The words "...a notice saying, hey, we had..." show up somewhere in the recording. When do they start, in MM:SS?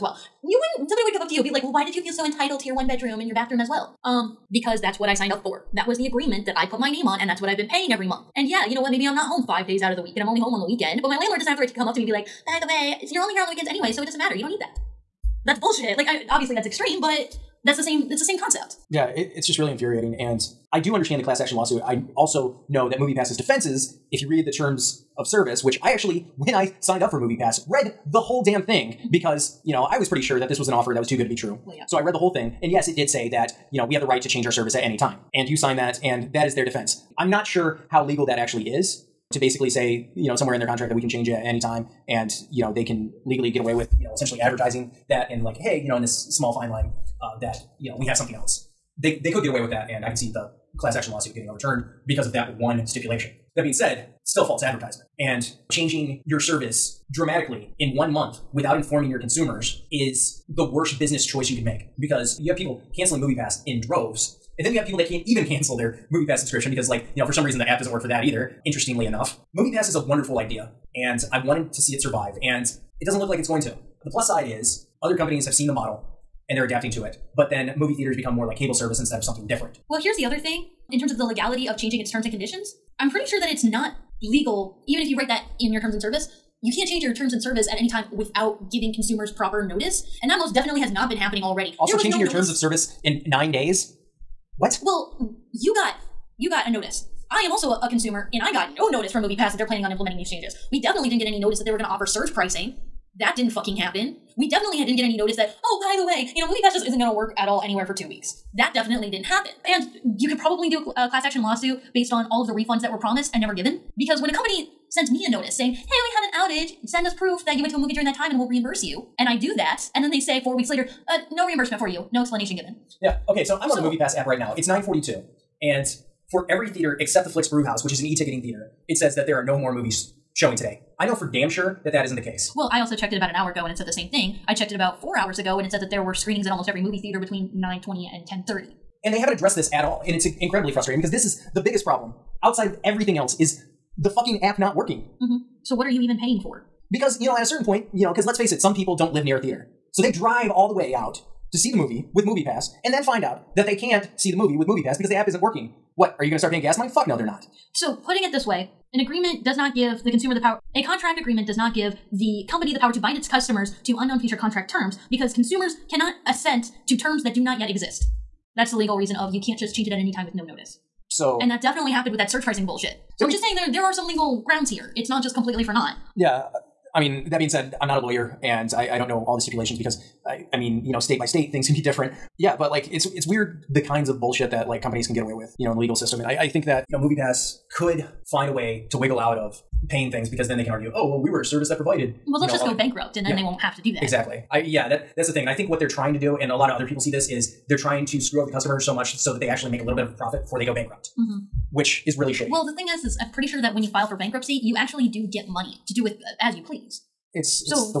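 01:55.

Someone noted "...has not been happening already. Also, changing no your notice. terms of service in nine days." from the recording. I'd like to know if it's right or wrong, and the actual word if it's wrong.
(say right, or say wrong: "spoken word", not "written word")
right.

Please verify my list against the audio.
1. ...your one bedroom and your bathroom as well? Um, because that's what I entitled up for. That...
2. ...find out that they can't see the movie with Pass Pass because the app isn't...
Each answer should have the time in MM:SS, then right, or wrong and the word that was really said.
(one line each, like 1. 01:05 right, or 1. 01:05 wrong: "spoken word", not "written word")
1. 00:02 wrong: "signed", not "entitled"
2. 02:33 wrong: "Movie", not "Pass".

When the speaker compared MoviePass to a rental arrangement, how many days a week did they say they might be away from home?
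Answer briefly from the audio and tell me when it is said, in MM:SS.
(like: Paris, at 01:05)
5, at 00:09.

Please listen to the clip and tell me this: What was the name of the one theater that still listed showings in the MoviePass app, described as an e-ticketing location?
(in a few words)
Flix Brewhouse.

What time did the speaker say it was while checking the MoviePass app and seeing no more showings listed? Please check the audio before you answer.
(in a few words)
9:42.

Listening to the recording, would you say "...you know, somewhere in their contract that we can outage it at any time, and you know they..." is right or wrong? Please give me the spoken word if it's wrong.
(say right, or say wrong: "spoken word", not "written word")
wrong: "change", not "outage".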